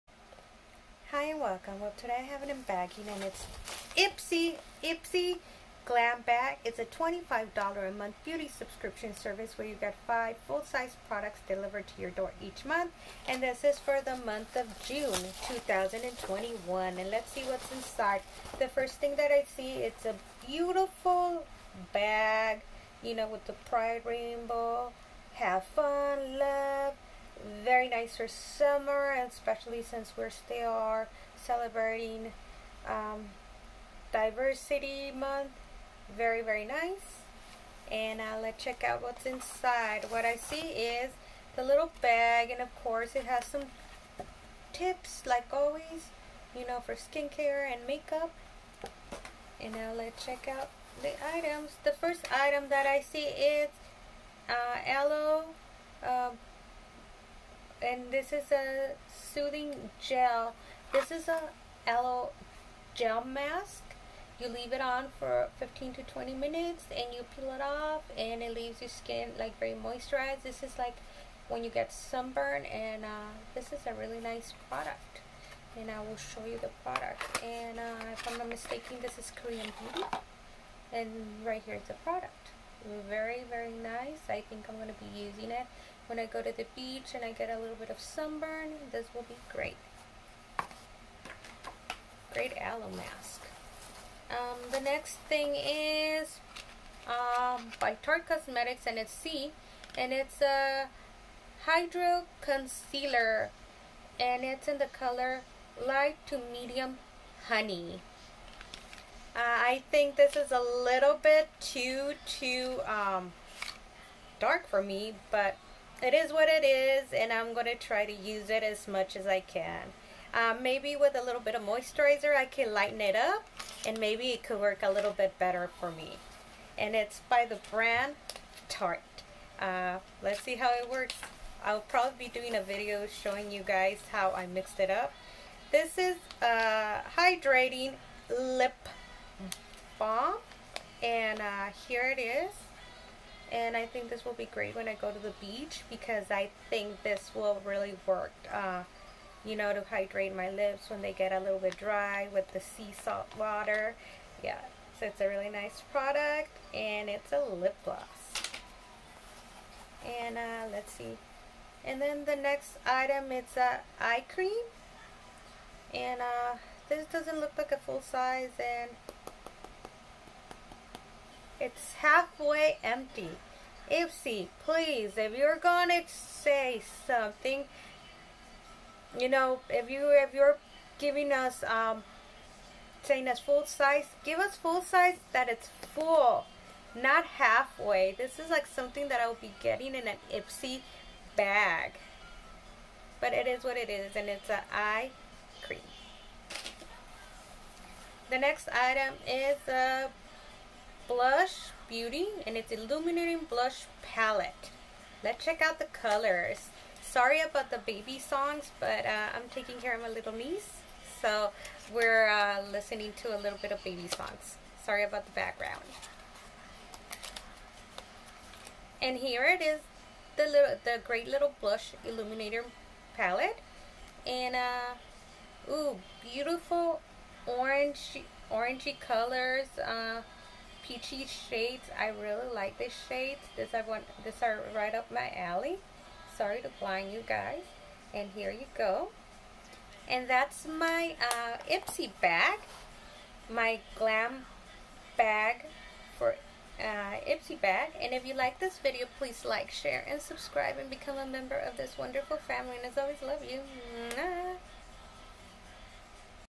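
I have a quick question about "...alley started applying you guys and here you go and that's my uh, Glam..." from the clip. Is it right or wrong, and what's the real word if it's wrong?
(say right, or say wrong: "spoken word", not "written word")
wrong: "Ipsy", not "Glam".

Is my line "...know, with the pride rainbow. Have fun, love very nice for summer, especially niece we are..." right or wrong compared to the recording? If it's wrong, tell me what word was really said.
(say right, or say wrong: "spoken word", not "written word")
wrong: "since", not "niece".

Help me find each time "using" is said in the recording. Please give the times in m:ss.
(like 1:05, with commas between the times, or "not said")
1:25.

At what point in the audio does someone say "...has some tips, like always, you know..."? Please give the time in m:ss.
0:43.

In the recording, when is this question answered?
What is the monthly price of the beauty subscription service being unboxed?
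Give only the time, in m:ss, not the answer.
0:06.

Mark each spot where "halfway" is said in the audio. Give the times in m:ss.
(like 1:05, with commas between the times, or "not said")
2:51, 3:07.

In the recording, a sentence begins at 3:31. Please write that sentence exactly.
So we're uh, listening to a little bit of baby songs.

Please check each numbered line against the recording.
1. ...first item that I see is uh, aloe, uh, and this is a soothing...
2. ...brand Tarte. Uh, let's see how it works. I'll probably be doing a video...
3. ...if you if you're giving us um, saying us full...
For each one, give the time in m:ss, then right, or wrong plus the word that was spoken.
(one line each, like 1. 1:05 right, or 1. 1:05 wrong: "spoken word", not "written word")
1. 0:51 right
2. 2:07 right
3. 2:59 right.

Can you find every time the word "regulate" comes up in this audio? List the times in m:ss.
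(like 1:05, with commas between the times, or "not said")
not said.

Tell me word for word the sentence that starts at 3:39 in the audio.
And here it is, the little, the great little blush illuminator palette.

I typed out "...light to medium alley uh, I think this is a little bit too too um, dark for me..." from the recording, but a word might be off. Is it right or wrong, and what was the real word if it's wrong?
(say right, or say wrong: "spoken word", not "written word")
wrong: "honey", not "alley".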